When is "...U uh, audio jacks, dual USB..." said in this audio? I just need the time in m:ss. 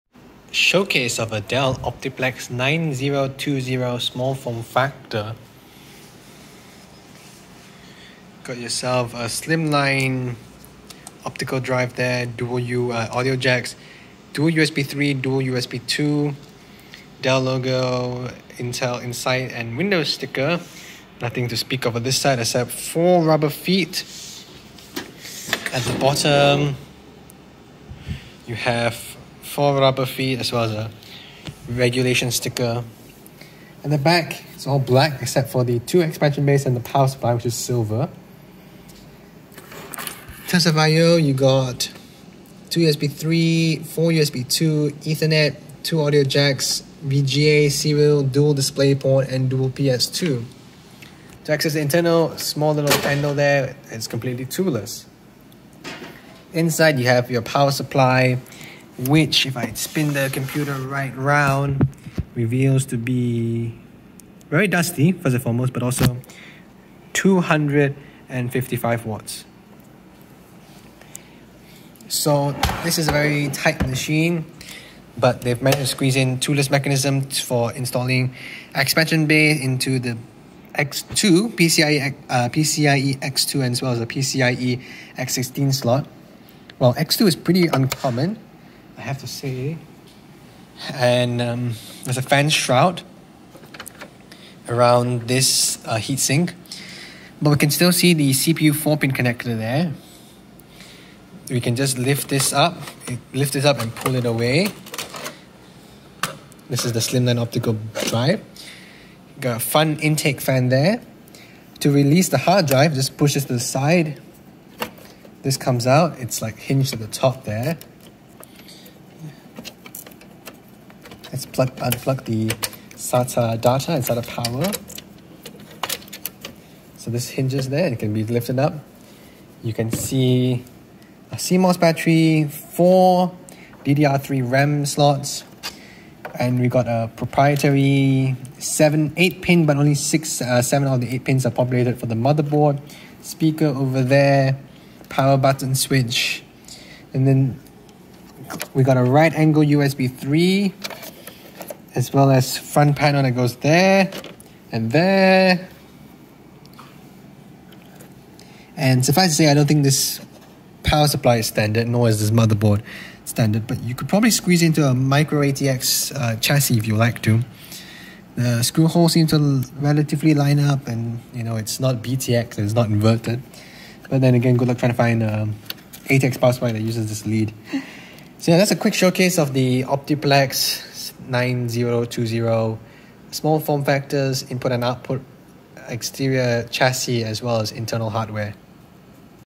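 0:12.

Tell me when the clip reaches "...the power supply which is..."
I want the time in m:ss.
0:36.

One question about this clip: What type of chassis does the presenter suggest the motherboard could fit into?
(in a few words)
micro ATX.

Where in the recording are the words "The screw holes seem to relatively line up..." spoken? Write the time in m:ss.
2:48.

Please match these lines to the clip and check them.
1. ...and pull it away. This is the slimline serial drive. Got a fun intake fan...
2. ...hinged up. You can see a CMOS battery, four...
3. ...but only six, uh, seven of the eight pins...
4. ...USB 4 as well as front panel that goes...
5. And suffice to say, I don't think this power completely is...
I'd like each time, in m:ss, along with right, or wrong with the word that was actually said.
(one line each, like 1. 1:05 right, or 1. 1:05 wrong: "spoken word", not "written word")
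1. 1:43 wrong: "optical", not "serial"
2. 2:08 wrong: "lifted", not "hinged"
3. 2:19 right
4. 2:29 wrong: "3", not "4"
5. 2:38 wrong: "supply", not "completely".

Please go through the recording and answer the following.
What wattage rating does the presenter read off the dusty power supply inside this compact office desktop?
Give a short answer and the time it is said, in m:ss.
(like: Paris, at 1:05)
255 watts, at 1:07.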